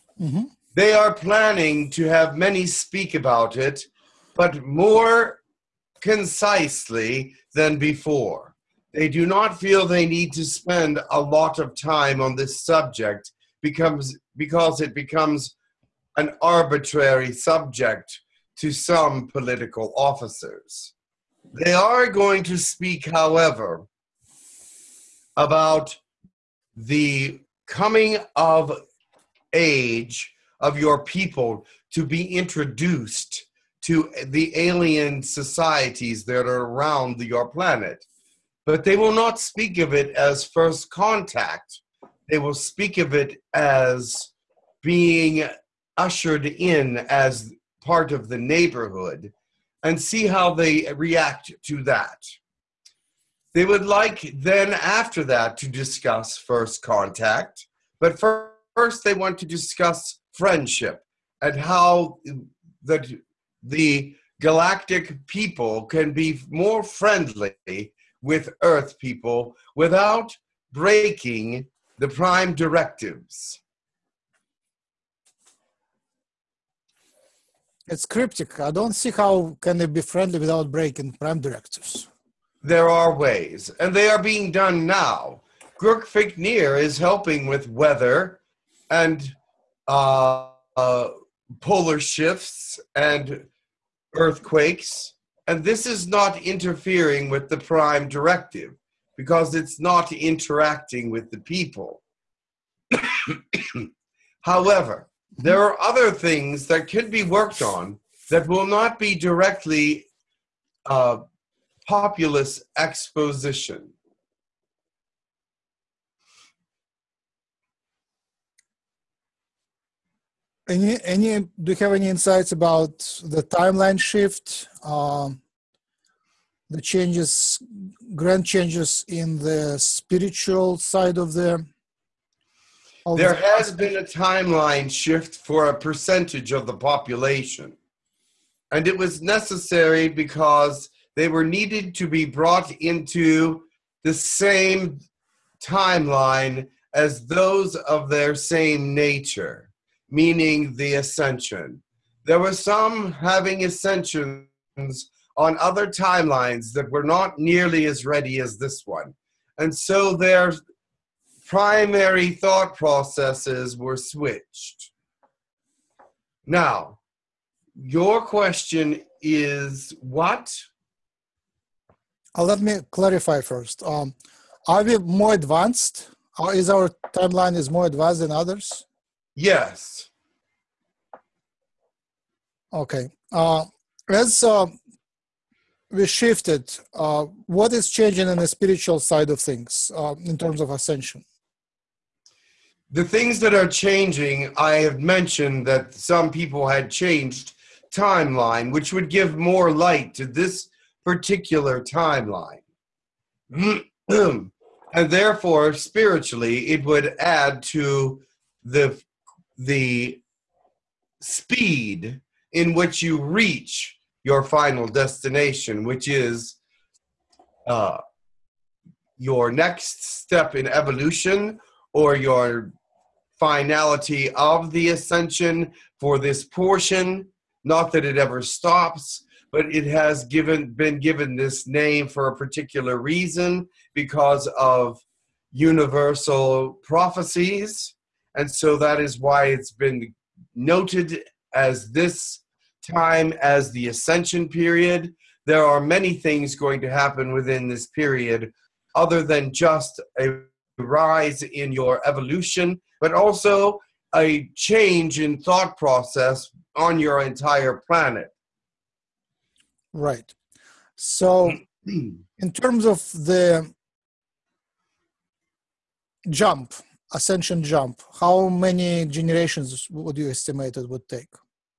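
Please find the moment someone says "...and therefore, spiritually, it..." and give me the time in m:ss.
3:24.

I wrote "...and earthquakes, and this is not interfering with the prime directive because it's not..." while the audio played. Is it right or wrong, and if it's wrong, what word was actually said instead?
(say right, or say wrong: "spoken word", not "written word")
right.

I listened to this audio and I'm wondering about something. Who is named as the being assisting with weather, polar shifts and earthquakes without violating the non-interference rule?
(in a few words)
Girk Fitneer.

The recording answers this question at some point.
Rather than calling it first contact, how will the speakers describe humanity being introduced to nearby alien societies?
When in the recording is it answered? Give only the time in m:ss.
0:47.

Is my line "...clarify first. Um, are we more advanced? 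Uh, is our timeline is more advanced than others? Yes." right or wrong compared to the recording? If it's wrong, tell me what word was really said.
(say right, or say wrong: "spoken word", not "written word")
right.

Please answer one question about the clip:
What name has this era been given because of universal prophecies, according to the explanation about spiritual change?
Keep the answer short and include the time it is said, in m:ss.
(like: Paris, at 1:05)
The ascension period, at 4:03.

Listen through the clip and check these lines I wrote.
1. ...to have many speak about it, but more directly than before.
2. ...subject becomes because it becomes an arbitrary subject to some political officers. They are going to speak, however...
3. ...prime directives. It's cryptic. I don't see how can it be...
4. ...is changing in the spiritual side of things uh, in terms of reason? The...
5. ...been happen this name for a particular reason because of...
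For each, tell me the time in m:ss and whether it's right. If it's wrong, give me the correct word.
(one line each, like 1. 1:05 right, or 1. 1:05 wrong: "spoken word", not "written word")
1. 0:01 wrong: "concisely", not "directly"
2. 0:12 right
3. 1:12 right
4. 3:07 wrong: "ascension", not "reason"
5. 3:50 wrong: "given", not "happen".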